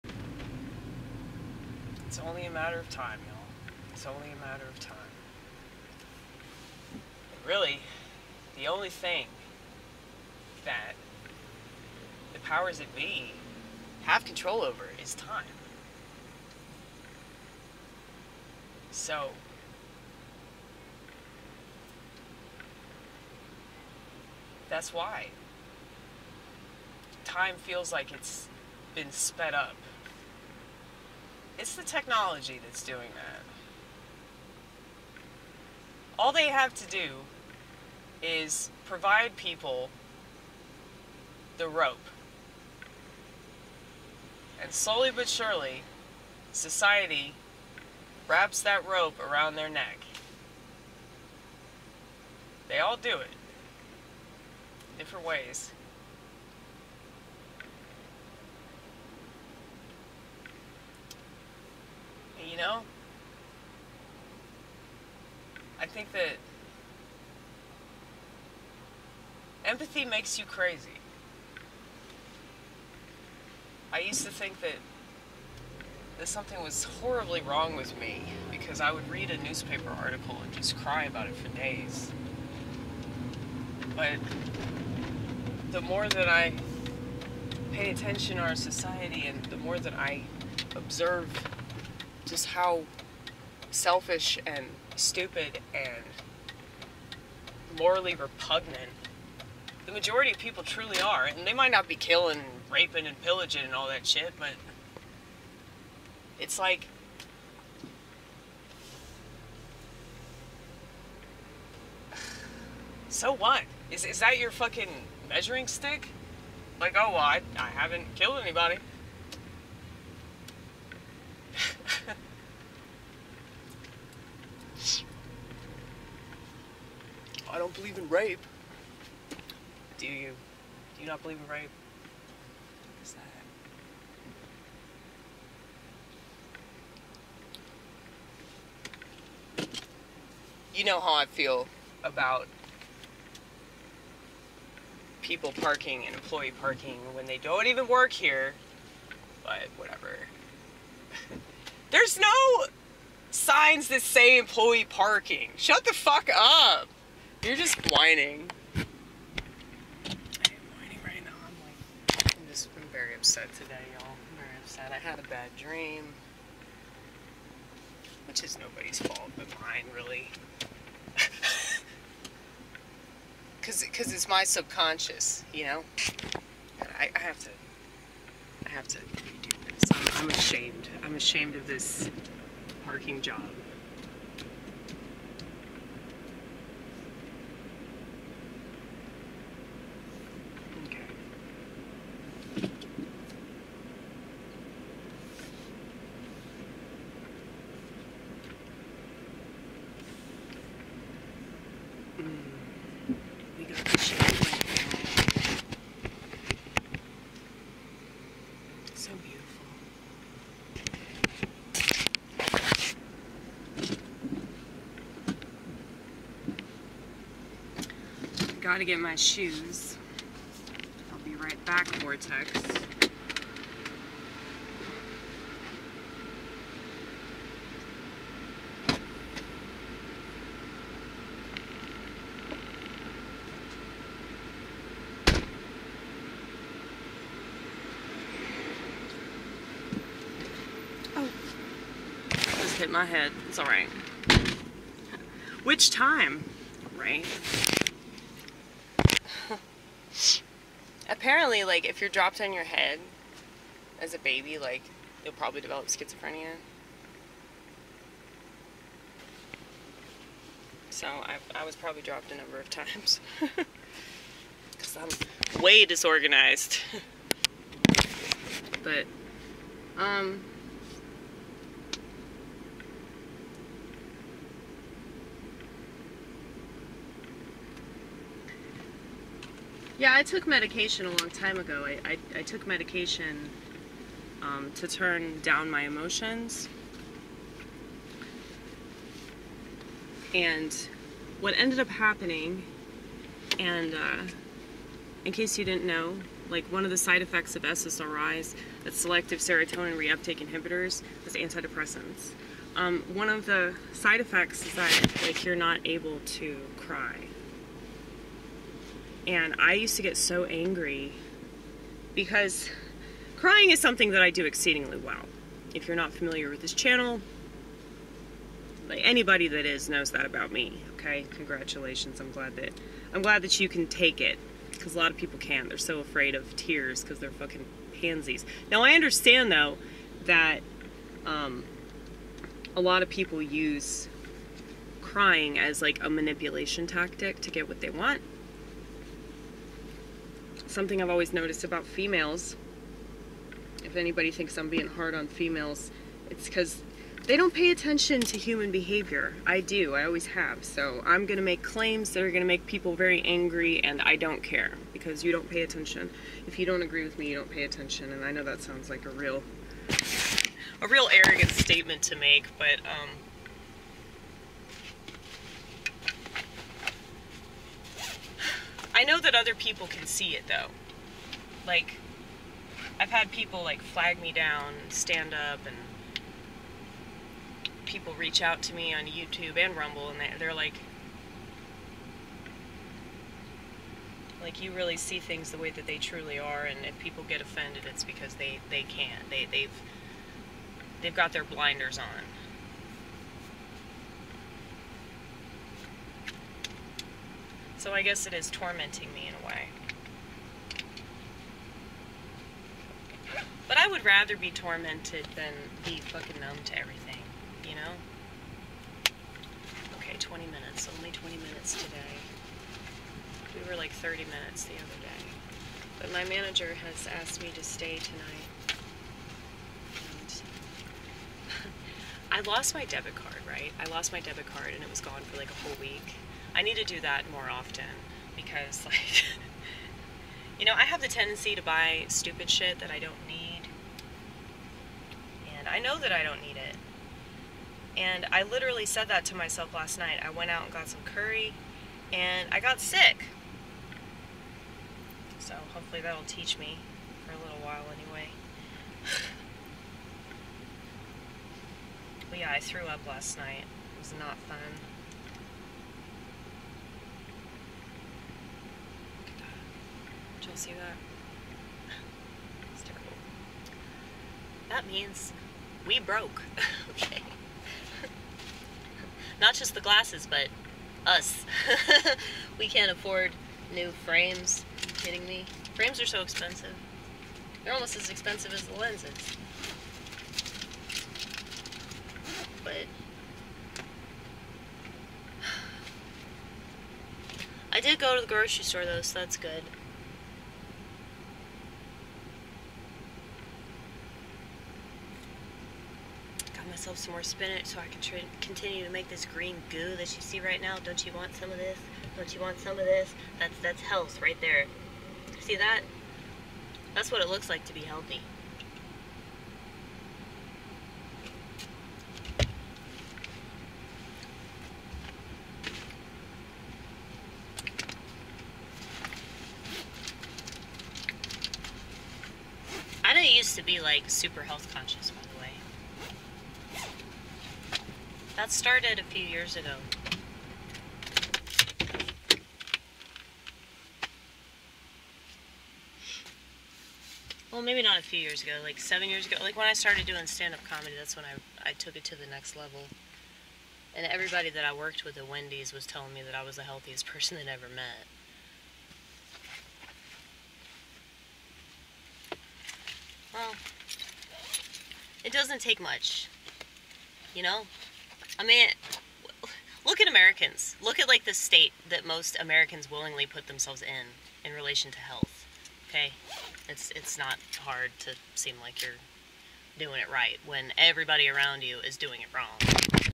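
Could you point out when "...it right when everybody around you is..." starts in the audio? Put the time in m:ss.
9:30.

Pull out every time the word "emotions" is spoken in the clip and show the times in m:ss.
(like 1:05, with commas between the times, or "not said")
4:45.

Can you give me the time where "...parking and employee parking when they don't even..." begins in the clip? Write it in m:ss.
2:25.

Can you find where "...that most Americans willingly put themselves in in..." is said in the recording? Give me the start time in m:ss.
9:21.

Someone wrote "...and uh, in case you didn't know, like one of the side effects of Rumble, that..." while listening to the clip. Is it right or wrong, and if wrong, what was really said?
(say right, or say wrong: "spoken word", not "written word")
wrong: "SSRIs", not "Rumble".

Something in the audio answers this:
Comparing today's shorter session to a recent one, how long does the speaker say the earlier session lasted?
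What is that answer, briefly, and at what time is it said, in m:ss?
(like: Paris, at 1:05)
30 minutes, at 6:53.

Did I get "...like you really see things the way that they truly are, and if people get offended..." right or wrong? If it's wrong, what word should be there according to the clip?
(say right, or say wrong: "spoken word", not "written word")
right.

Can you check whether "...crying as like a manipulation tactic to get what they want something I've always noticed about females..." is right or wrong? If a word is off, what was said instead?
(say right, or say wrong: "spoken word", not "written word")
right.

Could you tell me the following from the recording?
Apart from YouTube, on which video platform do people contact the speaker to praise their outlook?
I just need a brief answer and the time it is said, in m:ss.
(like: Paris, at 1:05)
Rumble, at 6:19.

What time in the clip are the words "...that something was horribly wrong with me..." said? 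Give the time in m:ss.
1:16.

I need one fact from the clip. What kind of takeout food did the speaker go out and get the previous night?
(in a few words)
curry.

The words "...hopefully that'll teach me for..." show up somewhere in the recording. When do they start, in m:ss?
7:25.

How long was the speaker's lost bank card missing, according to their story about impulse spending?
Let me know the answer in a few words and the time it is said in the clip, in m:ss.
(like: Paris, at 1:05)
a whole week, at 7:05.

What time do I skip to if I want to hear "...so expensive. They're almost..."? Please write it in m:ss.
7:56.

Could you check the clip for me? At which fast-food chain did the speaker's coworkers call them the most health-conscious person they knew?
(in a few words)
Wendy's.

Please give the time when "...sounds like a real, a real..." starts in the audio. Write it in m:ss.
5:58.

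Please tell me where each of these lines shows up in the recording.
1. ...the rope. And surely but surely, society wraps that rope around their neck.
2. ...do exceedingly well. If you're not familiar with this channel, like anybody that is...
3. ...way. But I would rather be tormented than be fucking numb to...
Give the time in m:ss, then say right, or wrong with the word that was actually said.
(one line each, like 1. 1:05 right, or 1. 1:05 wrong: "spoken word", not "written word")
1. 0:41 wrong: "slowly", not "surely"
2. 5:14 right
3. 6:39 right.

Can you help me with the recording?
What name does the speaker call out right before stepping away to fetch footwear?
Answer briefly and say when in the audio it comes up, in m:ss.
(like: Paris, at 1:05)
Vortex, at 3:41.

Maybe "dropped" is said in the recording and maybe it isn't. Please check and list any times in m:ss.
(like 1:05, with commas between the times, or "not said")
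4:12, 4:22.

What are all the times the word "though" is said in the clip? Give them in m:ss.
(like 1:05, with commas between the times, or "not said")
5:29, 6:10, 8:08.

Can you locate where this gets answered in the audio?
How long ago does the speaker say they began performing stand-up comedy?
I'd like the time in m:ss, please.
8:58.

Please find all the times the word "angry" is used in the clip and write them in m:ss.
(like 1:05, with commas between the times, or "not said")
5:10, 5:53.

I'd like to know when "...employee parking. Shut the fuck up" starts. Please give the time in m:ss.
2:34.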